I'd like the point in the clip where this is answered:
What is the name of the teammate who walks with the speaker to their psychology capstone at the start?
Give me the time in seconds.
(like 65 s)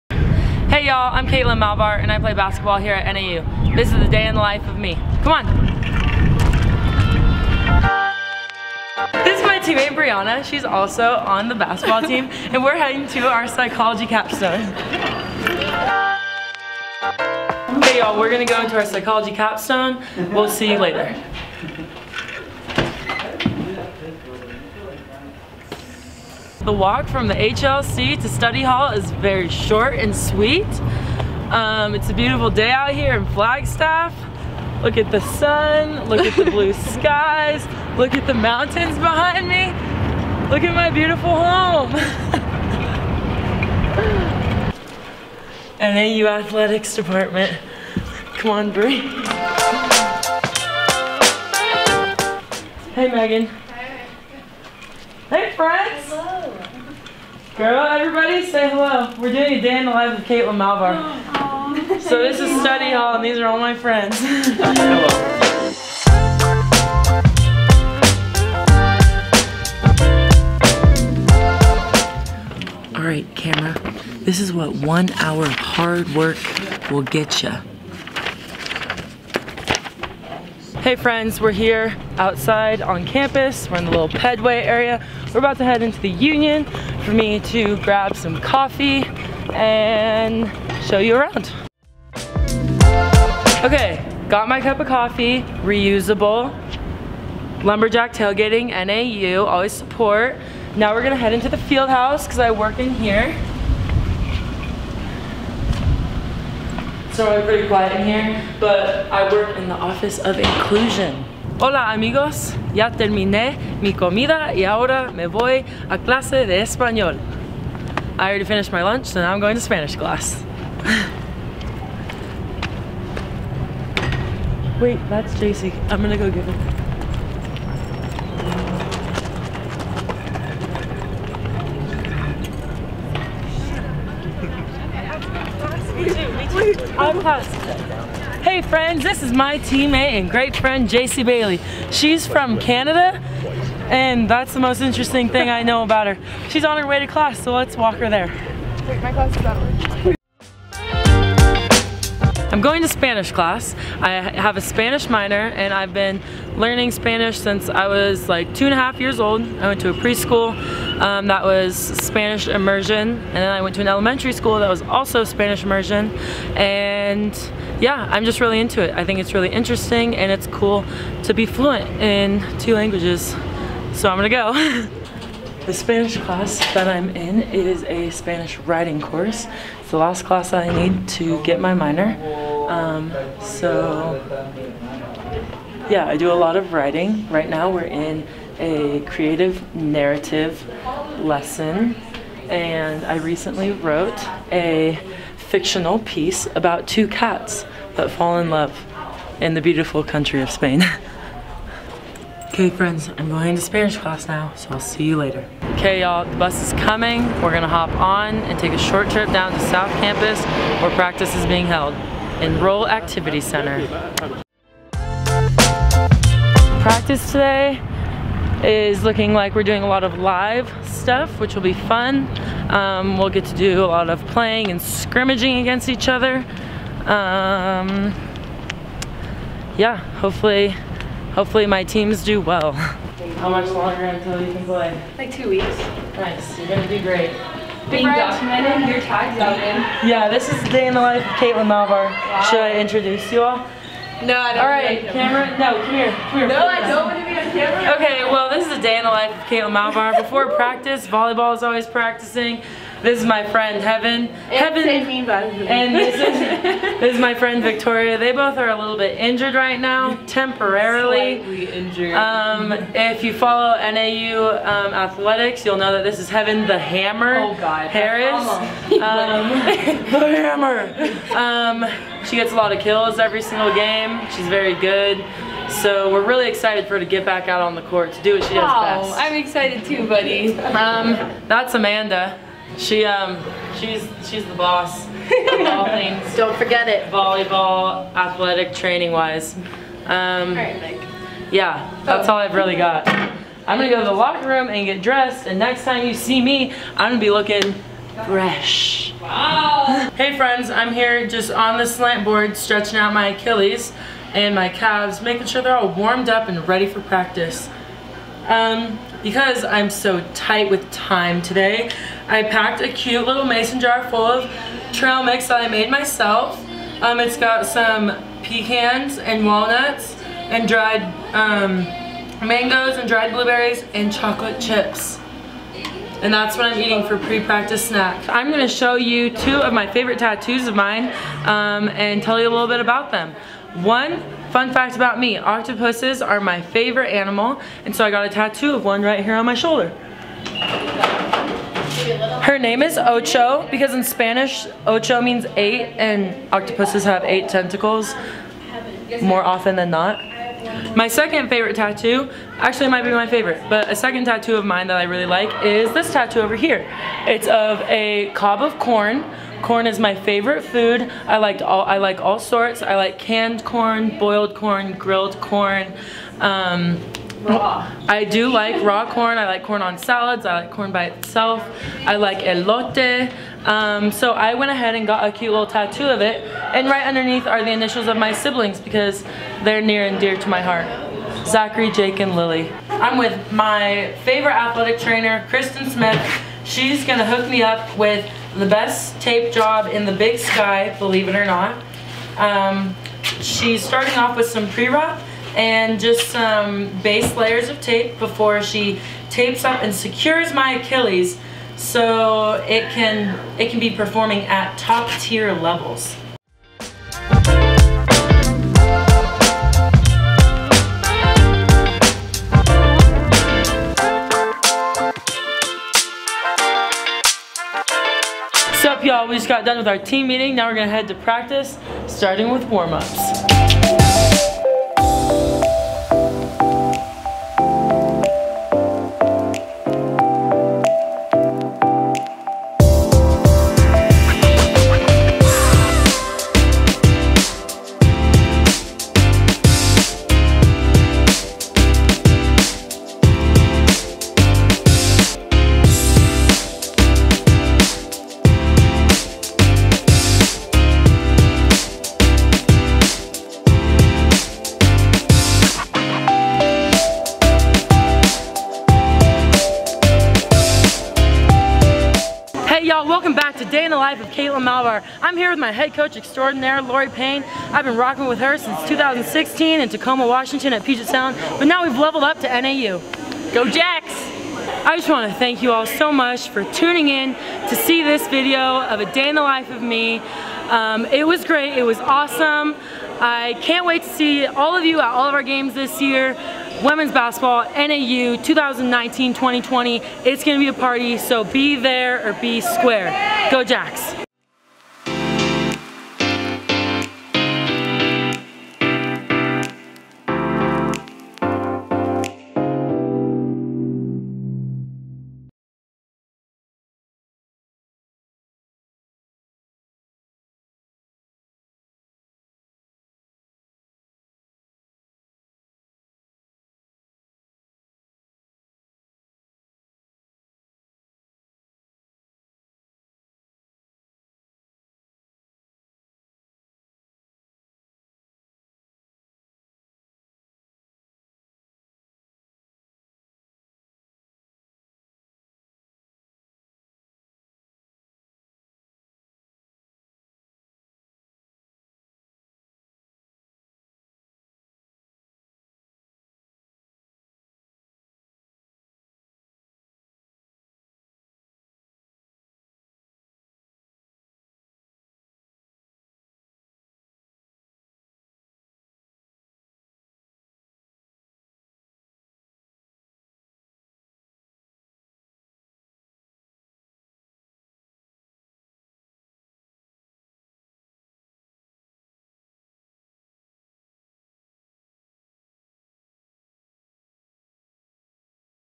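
9 s.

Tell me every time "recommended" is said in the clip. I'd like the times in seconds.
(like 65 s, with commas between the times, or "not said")
not said.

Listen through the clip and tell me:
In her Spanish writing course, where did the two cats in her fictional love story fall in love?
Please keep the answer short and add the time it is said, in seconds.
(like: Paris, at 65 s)
Spain, at 200 s.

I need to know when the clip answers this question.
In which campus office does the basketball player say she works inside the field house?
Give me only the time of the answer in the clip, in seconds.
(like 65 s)
109 s.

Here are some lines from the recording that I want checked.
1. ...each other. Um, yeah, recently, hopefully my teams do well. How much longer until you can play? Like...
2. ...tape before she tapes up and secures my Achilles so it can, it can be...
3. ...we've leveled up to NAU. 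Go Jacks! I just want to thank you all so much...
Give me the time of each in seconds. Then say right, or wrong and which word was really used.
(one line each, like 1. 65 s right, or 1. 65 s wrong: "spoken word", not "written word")
1. 225 s wrong: "hopefully", not "recently"
2. 397 s right
3. 471 s right.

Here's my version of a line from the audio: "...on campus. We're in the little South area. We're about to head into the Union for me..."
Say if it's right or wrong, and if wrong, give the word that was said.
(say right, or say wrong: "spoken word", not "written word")
wrong: "Pedway", not "South".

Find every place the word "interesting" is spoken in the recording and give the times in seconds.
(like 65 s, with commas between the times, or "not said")
144 s, 169 s.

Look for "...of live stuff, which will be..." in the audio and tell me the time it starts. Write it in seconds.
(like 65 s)
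220 s.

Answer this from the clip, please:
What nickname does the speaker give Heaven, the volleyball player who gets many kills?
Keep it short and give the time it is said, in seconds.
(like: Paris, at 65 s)
Heaven the Hammer, at 266 s.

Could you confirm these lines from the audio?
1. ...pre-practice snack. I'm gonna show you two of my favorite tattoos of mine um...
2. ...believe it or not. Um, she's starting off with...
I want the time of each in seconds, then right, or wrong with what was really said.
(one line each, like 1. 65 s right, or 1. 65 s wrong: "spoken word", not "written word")
1. 327 s right
2. 390 s right.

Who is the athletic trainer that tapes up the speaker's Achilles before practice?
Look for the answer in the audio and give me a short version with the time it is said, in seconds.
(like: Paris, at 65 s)
Kristen Smith, at 385 s.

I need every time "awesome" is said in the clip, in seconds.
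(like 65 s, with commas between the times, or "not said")
481 s.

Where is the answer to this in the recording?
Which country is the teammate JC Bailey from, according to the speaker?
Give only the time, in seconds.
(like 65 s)
142 s.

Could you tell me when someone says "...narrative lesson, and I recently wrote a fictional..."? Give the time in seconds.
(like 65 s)
189 s.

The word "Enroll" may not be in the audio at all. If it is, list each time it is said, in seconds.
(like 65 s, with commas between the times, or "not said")
212 s.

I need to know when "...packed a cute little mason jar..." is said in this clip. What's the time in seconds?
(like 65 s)
312 s.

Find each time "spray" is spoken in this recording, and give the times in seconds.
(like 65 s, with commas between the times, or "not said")
not said.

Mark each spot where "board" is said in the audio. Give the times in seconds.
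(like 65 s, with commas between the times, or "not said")
302 s.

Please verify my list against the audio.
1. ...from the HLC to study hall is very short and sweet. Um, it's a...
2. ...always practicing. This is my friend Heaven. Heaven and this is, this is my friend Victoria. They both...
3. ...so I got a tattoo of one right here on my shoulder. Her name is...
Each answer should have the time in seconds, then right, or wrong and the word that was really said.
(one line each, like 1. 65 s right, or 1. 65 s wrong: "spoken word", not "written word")
1. 27 s right
2. 251 s right
3. 337 s right.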